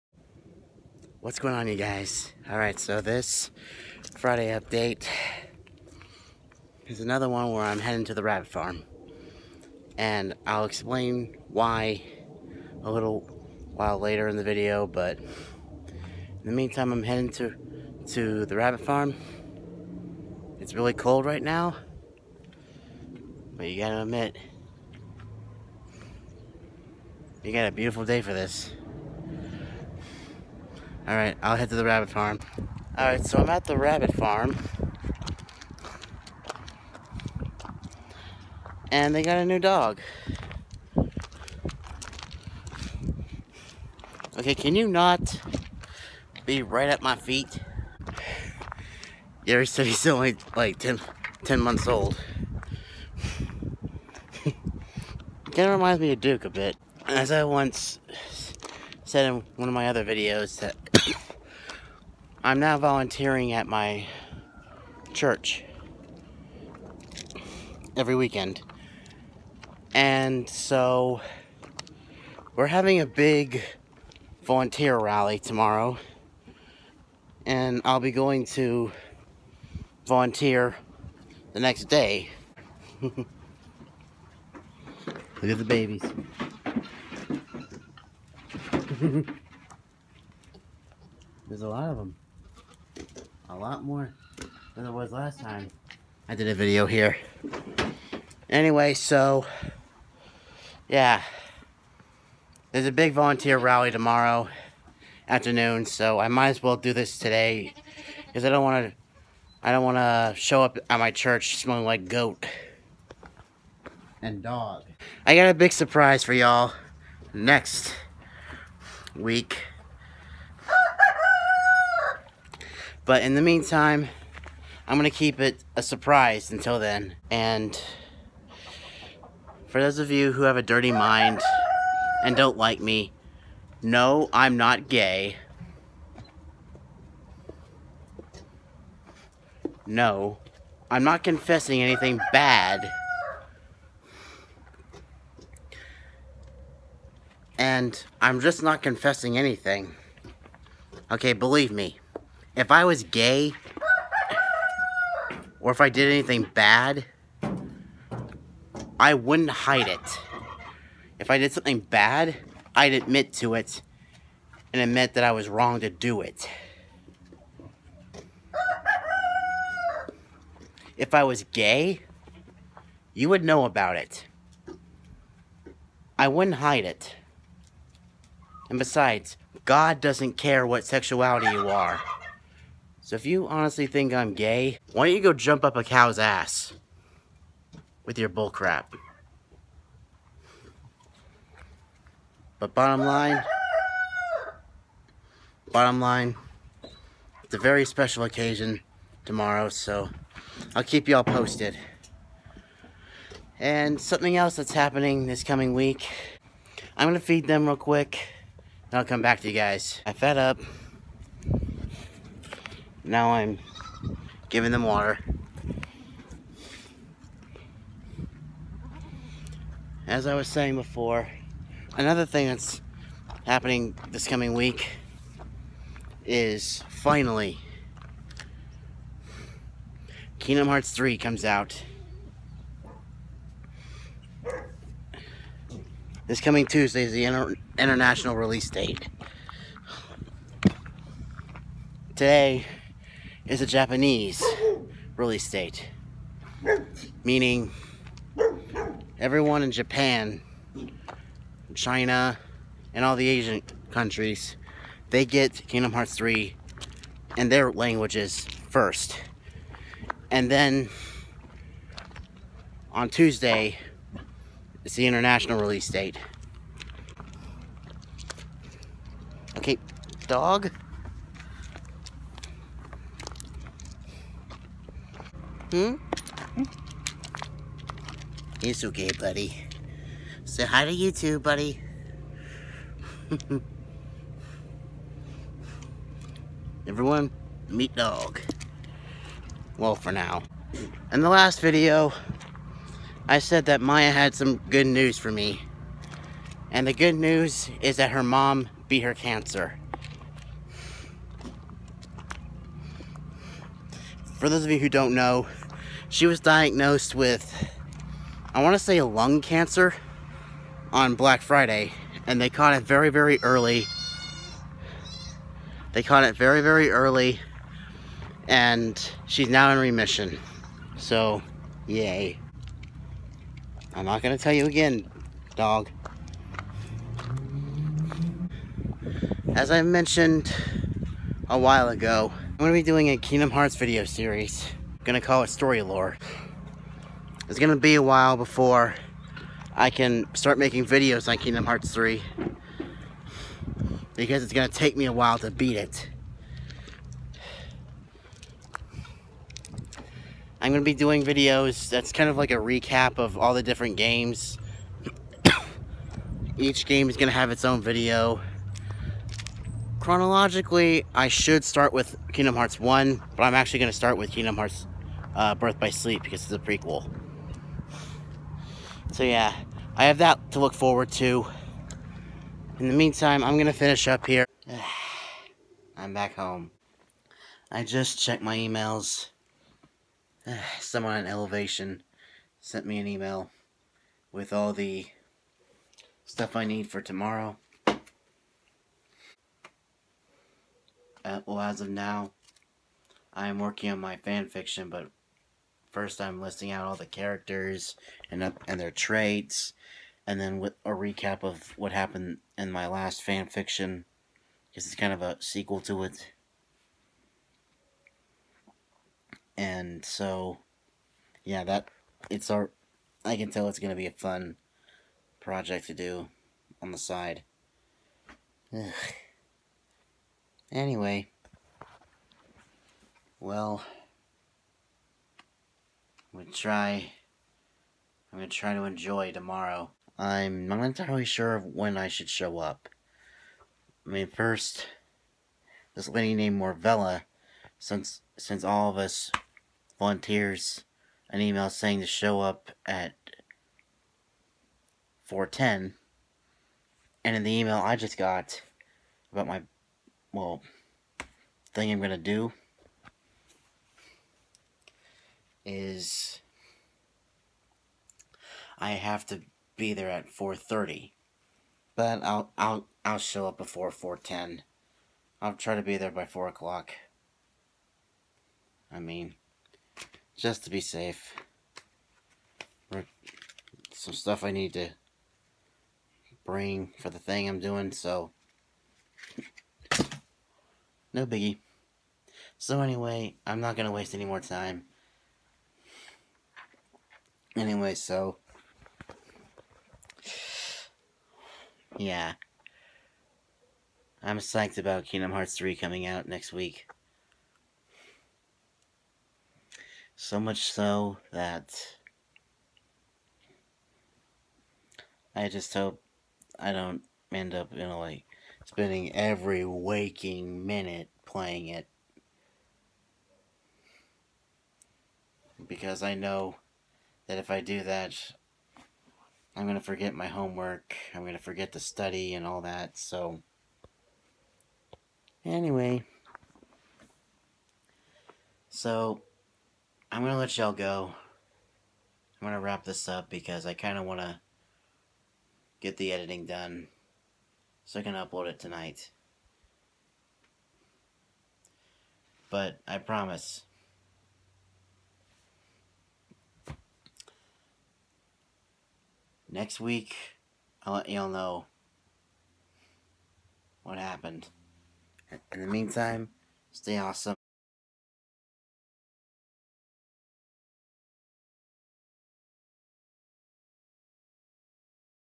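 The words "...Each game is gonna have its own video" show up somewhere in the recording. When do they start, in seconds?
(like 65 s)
356 s.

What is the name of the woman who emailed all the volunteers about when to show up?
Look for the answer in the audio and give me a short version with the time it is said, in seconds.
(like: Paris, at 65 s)
Morvella, at 436 s.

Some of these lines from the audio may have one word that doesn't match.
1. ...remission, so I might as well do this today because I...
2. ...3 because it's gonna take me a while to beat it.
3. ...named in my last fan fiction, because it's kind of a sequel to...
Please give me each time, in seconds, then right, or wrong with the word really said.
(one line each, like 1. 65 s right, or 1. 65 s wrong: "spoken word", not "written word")
1. 105 s wrong: "afternoon", not "remission"
2. 341 s right
3. 401 s wrong: "happened", not "named".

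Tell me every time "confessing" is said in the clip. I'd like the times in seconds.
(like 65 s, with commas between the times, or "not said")
141 s, 148 s.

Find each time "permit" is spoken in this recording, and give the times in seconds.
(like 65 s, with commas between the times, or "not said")
not said.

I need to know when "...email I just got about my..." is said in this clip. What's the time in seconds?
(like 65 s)
447 s.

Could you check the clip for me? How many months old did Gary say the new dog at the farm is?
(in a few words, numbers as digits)
10.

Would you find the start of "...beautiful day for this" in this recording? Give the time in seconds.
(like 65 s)
27 s.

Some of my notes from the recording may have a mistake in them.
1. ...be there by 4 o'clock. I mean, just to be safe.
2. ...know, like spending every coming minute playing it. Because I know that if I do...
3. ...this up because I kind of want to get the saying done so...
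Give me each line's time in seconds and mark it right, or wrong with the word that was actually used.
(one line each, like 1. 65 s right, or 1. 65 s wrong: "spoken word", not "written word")
1. 465 s right
2. 507 s wrong: "waking", not "coming"
3. 532 s wrong: "editing", not "saying".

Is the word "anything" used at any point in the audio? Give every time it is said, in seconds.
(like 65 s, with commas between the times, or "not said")
141 s, 149 s, 156 s.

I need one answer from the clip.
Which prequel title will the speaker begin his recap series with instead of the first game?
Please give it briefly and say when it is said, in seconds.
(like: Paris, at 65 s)
Birth by Sleep, at 365 s.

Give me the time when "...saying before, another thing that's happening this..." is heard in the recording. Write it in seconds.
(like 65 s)
220 s.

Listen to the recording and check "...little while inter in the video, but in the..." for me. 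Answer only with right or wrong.
wrong.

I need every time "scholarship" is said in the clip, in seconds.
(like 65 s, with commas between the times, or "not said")
not said.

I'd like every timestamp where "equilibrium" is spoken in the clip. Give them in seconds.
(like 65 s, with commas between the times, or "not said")
not said.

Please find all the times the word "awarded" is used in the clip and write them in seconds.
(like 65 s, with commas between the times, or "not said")
not said.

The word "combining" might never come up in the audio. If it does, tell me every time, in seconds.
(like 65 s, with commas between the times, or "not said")
not said.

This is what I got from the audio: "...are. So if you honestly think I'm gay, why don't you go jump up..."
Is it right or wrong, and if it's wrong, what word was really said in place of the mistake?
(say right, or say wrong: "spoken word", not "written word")
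right.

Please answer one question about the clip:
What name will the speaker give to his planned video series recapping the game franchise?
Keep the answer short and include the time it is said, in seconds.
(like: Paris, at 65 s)
Story Lore, at 335 s.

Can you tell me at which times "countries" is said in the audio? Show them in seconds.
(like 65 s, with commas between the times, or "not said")
253 s.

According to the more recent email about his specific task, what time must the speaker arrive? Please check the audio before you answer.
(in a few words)
4:30.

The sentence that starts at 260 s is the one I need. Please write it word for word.
And then on Tuesday, it's the international release date.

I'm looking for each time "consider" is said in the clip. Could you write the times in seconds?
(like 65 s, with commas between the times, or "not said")
not said.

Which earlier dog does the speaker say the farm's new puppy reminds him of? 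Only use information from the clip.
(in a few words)
Duke.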